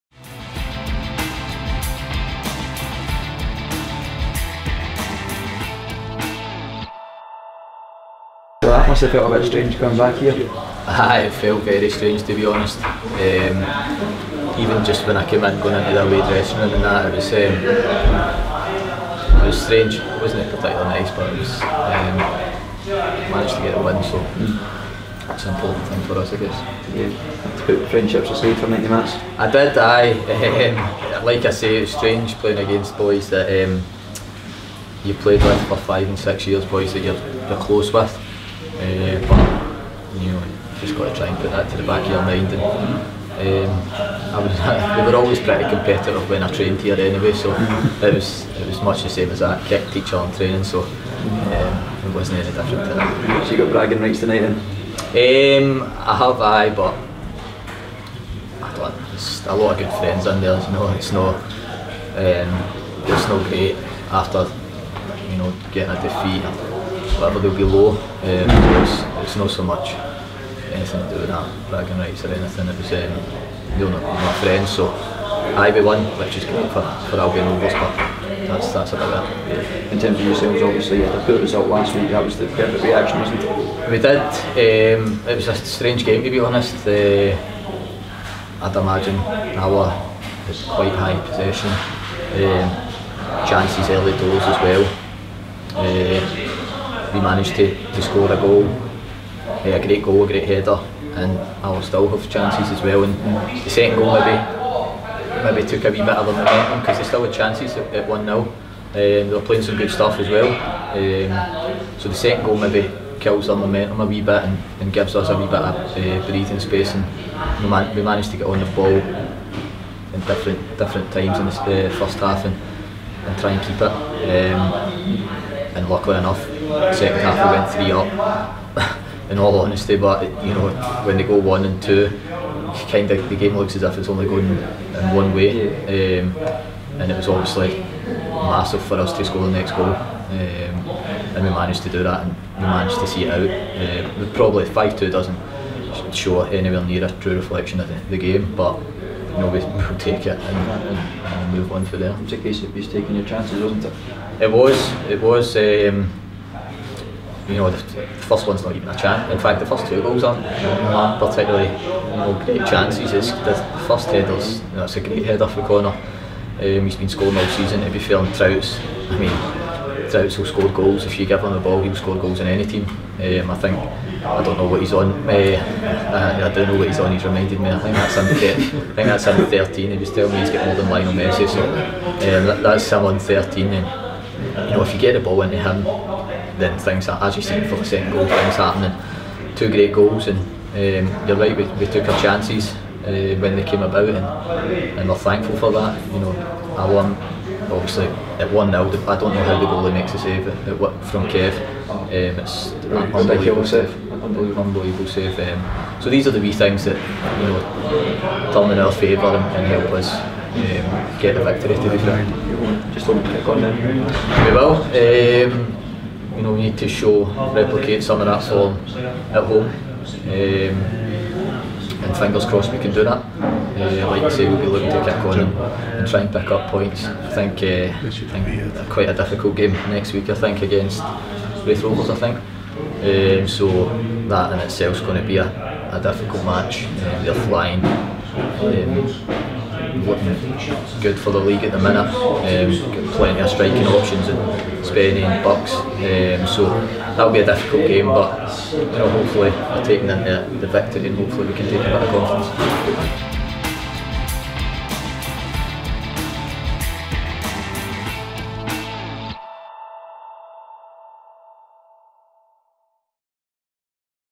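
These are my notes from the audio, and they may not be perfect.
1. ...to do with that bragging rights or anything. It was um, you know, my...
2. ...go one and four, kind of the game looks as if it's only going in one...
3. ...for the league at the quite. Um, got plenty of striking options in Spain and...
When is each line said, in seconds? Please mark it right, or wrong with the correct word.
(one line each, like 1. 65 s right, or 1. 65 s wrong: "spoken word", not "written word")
1. 71 s right
2. 131 s wrong: "two", not "four"
3. 241 s wrong: "minute", not "quite".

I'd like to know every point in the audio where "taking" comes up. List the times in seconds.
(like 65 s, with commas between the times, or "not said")
152 s, 249 s.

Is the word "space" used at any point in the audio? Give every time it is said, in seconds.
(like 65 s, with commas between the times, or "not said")
116 s.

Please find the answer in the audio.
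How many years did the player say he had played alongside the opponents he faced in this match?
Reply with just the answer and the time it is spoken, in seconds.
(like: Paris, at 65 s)
5 and 6 years, at 35 s.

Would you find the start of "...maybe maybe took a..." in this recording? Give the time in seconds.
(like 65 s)
104 s.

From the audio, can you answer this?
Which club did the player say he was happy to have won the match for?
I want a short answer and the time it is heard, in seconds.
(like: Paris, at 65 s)
Albion Rovers, at 77 s.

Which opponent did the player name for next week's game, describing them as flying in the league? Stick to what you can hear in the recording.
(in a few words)
Raith Rovers.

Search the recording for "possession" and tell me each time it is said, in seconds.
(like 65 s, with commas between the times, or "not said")
91 s.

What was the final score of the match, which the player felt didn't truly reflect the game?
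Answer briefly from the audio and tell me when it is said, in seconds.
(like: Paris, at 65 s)
5 2, at 144 s.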